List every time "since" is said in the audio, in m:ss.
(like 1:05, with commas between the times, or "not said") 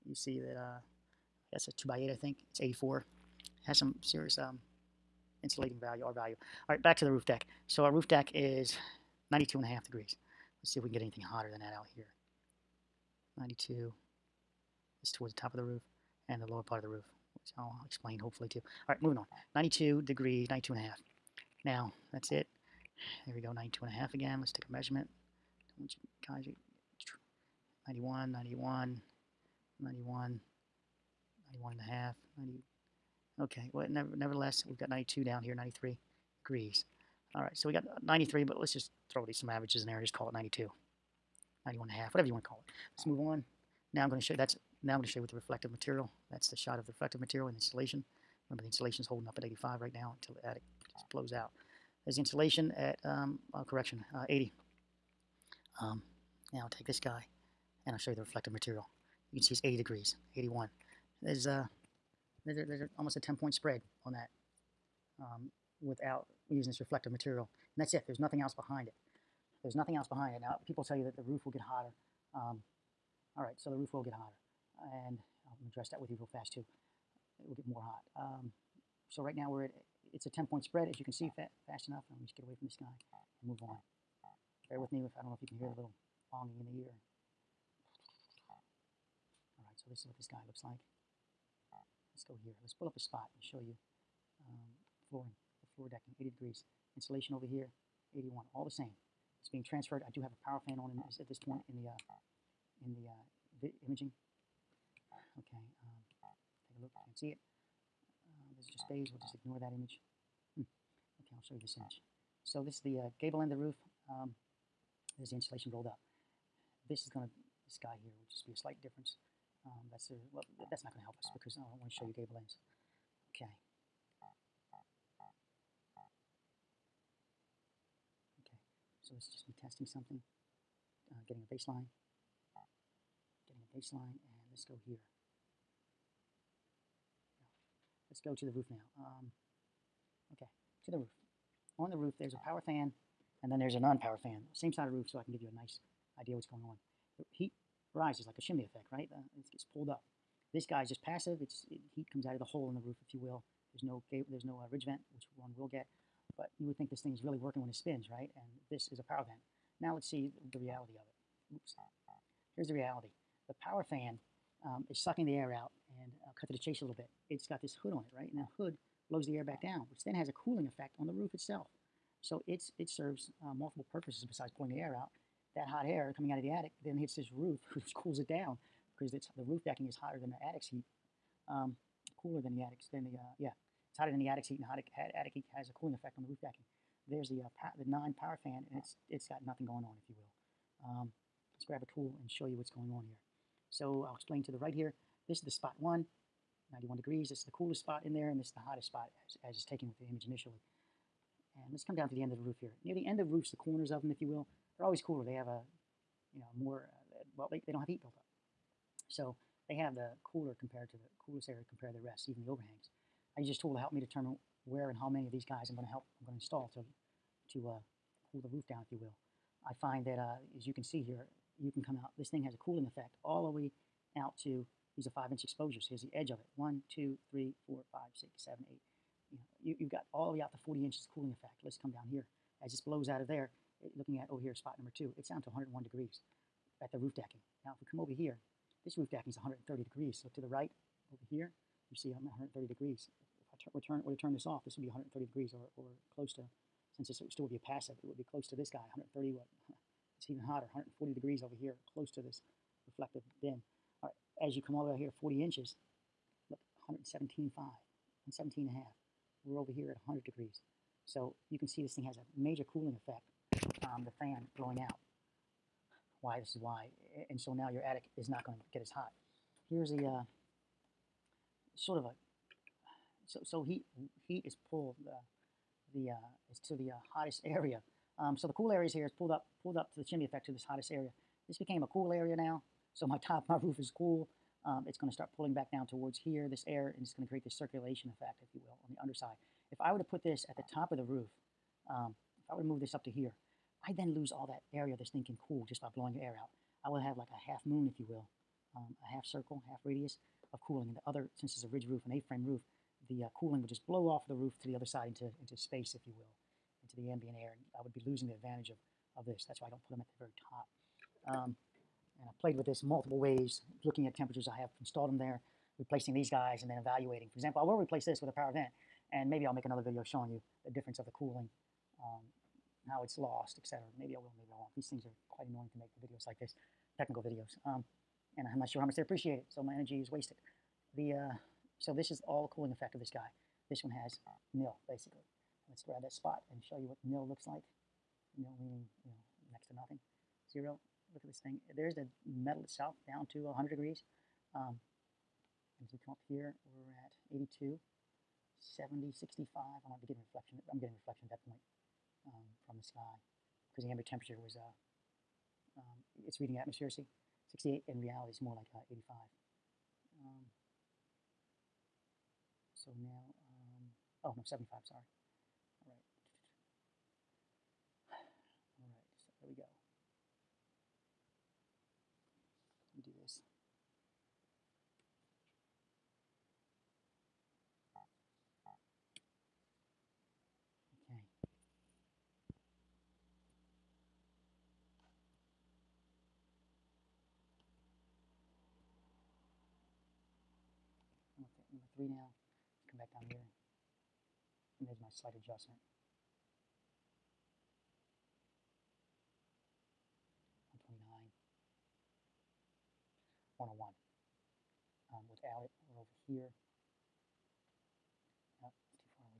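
4:06, 5:01.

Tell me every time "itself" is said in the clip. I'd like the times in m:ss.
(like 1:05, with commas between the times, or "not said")
2:51, 5:42.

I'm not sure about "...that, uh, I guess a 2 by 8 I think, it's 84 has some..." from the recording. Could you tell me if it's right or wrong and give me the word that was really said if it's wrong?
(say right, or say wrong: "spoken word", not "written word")
right.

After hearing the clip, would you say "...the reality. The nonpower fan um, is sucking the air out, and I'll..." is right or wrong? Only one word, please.
wrong.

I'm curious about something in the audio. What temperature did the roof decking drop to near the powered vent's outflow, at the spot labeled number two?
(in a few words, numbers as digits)
101 degrees.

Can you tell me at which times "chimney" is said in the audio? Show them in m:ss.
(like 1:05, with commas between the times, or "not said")
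2:28, 4:40.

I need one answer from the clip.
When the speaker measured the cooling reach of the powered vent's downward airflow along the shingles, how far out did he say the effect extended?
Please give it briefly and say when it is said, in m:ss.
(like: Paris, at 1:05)
40 inches, at 3:50.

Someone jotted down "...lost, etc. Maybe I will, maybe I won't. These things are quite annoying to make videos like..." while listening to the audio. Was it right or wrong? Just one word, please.
right.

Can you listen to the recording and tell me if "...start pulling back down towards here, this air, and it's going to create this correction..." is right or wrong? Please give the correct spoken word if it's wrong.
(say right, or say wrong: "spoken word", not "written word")
wrong: "circulation", not "correction".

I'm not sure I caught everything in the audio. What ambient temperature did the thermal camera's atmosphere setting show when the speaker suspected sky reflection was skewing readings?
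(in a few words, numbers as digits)
68.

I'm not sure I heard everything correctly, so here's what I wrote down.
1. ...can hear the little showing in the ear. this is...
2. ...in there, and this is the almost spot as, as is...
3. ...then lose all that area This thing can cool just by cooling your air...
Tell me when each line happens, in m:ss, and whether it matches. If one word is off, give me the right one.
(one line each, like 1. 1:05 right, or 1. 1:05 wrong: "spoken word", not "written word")
1. 1:25 wrong: "longing", not "showing"
2. 3:18 wrong: "hottest", not "almost"
3. 4:53 wrong: "blowing", not "cooling".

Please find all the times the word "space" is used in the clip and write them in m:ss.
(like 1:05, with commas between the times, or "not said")
5:05.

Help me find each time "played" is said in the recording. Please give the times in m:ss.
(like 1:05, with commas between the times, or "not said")
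5:12.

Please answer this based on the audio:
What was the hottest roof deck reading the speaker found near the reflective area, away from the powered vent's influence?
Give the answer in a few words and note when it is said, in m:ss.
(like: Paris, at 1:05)
140 degrees, at 4:10.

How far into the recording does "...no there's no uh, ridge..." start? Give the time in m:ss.
2:33.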